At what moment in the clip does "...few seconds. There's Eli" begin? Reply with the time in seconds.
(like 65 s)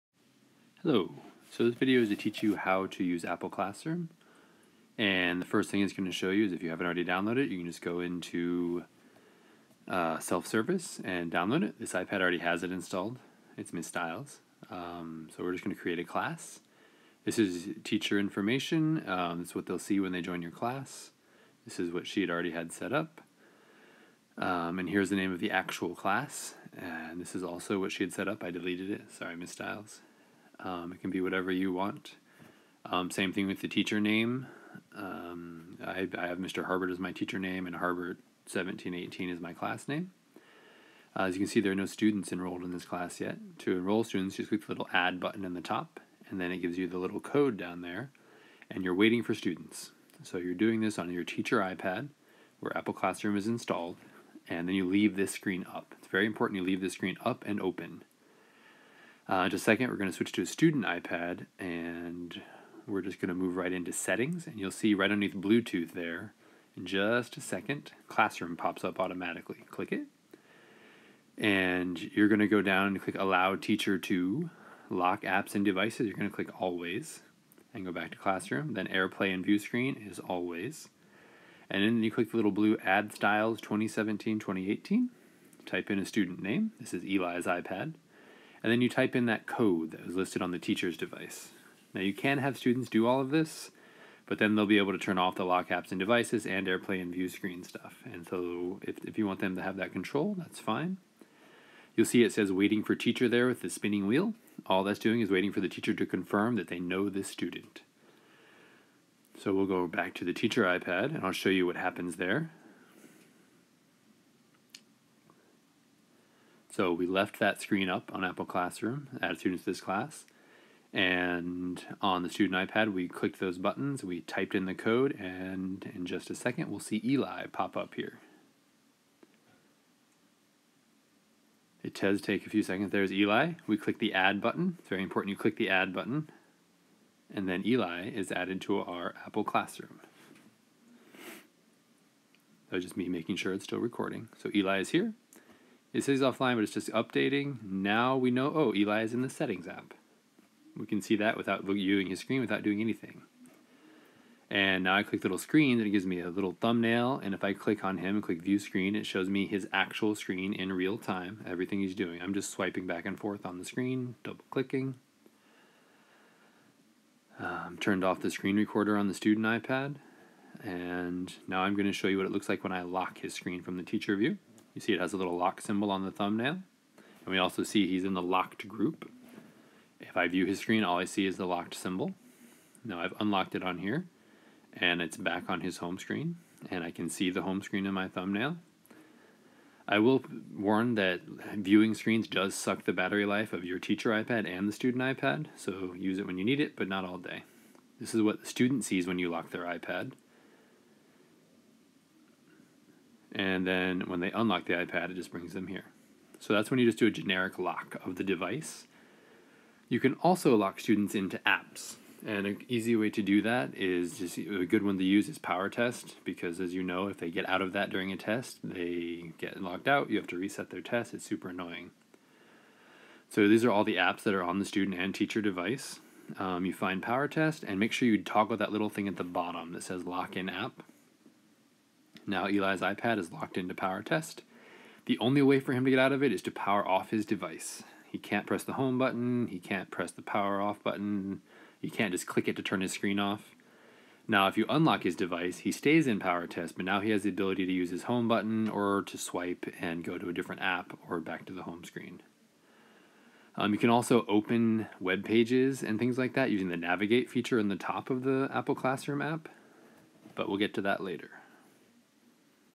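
132 s.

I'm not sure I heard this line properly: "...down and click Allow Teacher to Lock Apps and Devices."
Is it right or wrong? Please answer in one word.
right.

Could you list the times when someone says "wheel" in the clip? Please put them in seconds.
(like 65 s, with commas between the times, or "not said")
104 s.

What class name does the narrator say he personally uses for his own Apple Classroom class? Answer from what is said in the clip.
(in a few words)
Harbert 1718.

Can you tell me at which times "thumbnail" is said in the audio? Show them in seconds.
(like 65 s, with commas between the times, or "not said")
156 s, 176 s, 188 s.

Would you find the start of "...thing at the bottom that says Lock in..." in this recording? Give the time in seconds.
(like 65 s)
228 s.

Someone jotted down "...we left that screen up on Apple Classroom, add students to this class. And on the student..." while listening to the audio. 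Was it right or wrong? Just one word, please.
right.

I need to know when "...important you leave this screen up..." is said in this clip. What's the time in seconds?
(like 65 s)
56 s.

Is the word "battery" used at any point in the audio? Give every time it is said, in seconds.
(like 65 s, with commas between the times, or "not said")
192 s.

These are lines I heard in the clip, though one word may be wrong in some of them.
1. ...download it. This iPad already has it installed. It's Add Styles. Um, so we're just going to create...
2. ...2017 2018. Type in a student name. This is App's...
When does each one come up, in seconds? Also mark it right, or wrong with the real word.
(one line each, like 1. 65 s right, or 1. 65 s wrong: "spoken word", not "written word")
1. 11 s wrong: "Miss", not "Add"
2. 83 s wrong: "Eli", not "App".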